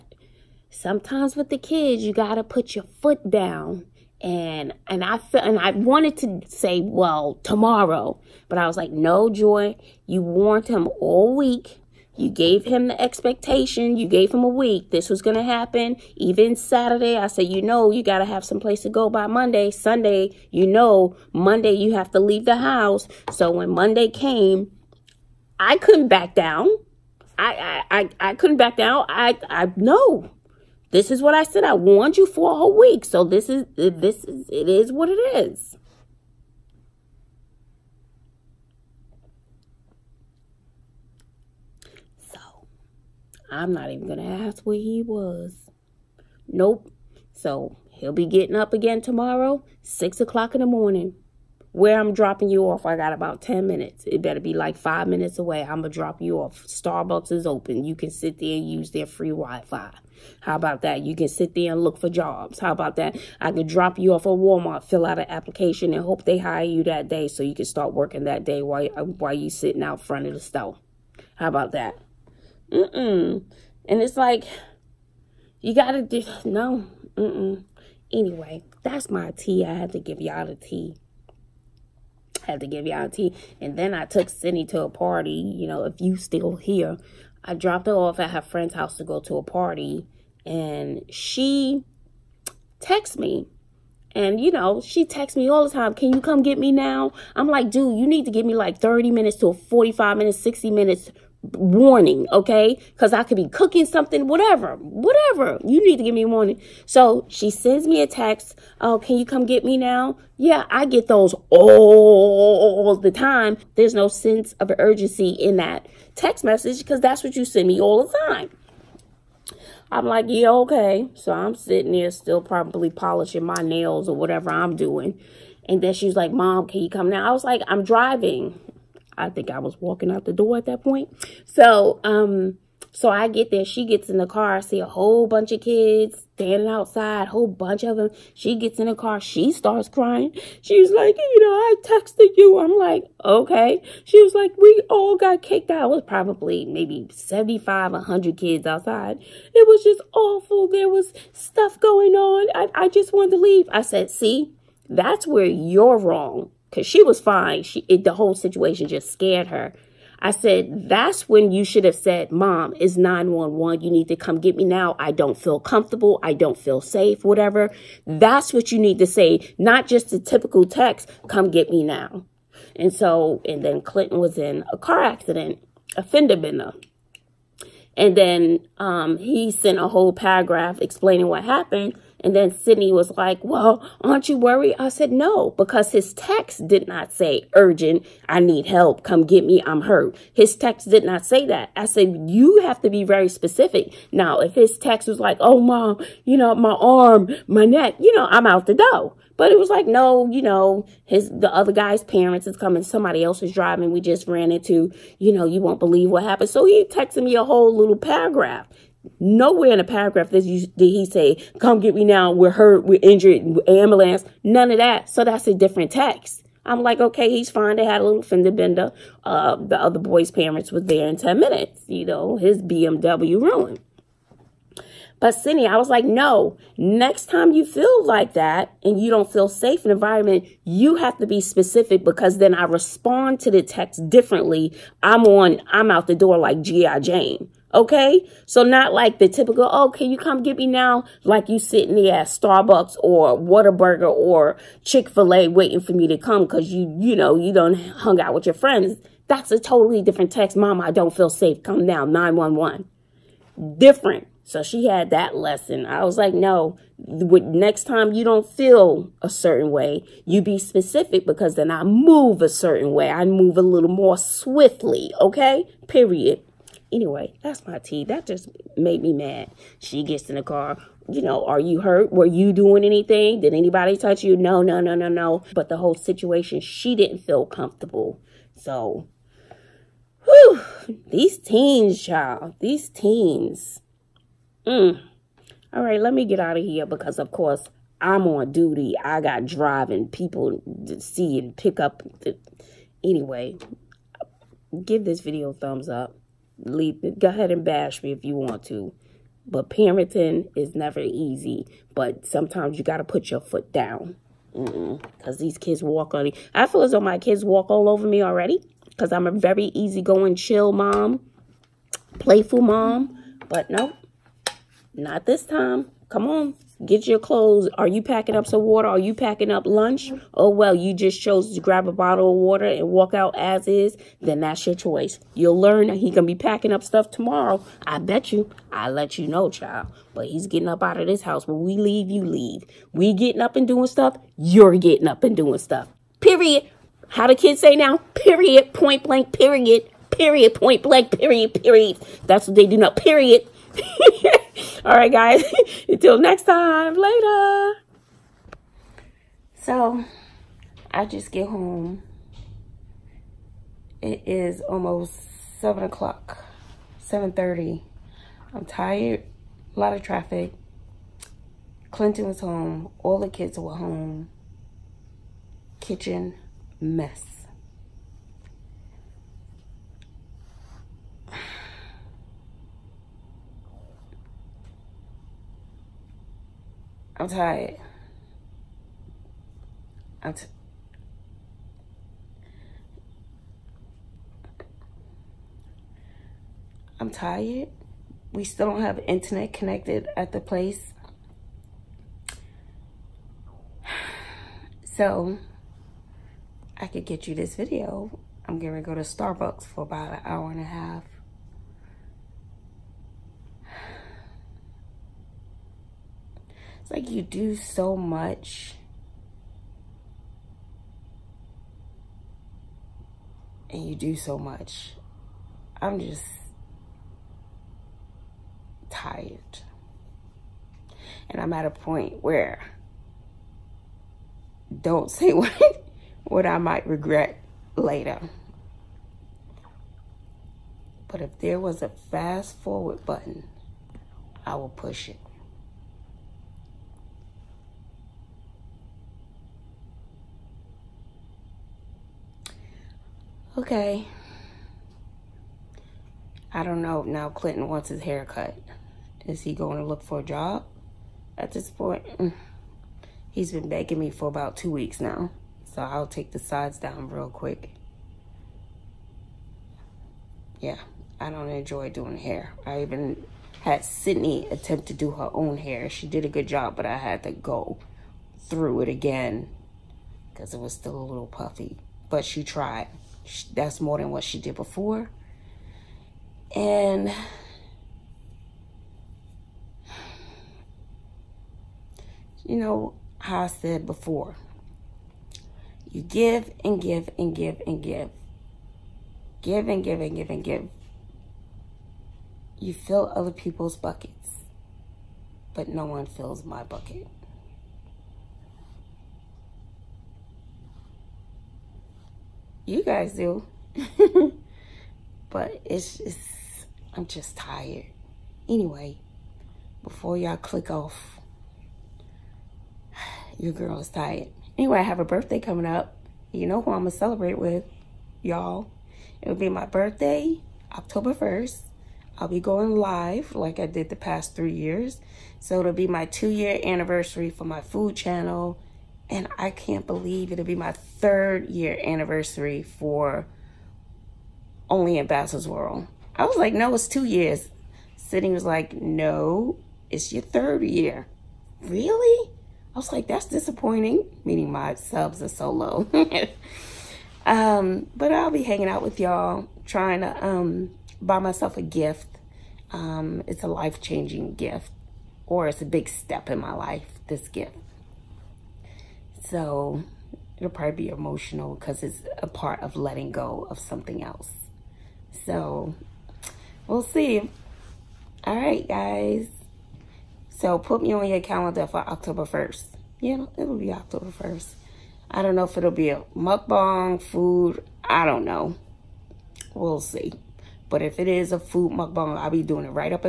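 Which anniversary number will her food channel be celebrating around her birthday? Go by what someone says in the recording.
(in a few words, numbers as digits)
2.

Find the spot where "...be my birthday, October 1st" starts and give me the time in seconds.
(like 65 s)
519 s.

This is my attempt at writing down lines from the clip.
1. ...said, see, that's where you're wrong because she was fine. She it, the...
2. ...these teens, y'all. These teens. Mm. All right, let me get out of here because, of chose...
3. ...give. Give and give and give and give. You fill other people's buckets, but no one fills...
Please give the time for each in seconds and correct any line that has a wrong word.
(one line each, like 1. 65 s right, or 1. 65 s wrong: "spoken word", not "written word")
1. 153 s right
2. 281 s wrong: "course", not "chose"
3. 487 s right.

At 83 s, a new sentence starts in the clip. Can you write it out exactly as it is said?
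And then I took Sydney to a party, you know, if you still here.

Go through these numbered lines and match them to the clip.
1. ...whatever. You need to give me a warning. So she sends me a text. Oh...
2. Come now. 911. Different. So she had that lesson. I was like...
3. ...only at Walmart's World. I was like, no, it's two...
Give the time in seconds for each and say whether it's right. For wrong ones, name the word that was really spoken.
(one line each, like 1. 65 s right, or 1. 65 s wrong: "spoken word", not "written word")
1. 104 s right
2. 251 s right
3. 534 s wrong: "Bazzle", not "Walmart".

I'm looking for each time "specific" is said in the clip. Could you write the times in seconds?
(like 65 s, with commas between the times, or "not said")
193 s, 231 s, 260 s.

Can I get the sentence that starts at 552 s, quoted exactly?
Um, it's a life-changing gift, or it's a big step in my life, this gift.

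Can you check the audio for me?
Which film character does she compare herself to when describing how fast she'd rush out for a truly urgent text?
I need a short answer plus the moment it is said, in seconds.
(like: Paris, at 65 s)
G.I. Jane, at 236 s.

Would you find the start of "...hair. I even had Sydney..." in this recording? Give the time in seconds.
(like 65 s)
462 s.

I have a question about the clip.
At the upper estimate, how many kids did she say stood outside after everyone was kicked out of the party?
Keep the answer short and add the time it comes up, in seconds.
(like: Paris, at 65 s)
100, at 147 s.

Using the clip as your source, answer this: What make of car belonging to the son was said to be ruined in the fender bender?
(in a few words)
BMW.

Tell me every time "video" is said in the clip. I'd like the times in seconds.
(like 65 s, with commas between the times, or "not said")
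295 s, 397 s.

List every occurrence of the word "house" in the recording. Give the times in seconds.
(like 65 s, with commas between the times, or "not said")
22 s, 88 s, 331 s.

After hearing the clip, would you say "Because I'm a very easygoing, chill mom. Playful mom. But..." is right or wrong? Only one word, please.
right.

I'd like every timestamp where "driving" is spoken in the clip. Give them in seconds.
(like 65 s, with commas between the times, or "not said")
127 s, 203 s, 289 s.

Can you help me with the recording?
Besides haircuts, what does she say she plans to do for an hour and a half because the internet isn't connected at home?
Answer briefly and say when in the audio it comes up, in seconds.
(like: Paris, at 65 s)
go to Starbucks, at 398 s.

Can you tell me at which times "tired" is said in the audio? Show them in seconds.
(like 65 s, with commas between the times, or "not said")
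358 s, 377 s, 387 s, 418 s, 507 s, 513 s.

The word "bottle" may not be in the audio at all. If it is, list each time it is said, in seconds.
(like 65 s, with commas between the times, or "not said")
321 s.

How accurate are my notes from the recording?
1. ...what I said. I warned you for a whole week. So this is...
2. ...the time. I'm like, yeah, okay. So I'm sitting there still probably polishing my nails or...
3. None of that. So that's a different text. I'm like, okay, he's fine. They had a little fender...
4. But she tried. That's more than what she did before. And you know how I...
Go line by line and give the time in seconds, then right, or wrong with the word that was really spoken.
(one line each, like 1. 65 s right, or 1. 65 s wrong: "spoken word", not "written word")
1. 31 s right
2. 118 s right
3. 214 s right
4. 472 s right.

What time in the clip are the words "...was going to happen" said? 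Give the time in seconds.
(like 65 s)
15 s.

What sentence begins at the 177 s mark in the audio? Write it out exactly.
And then um, he sent a whole paragraph explaining what happened.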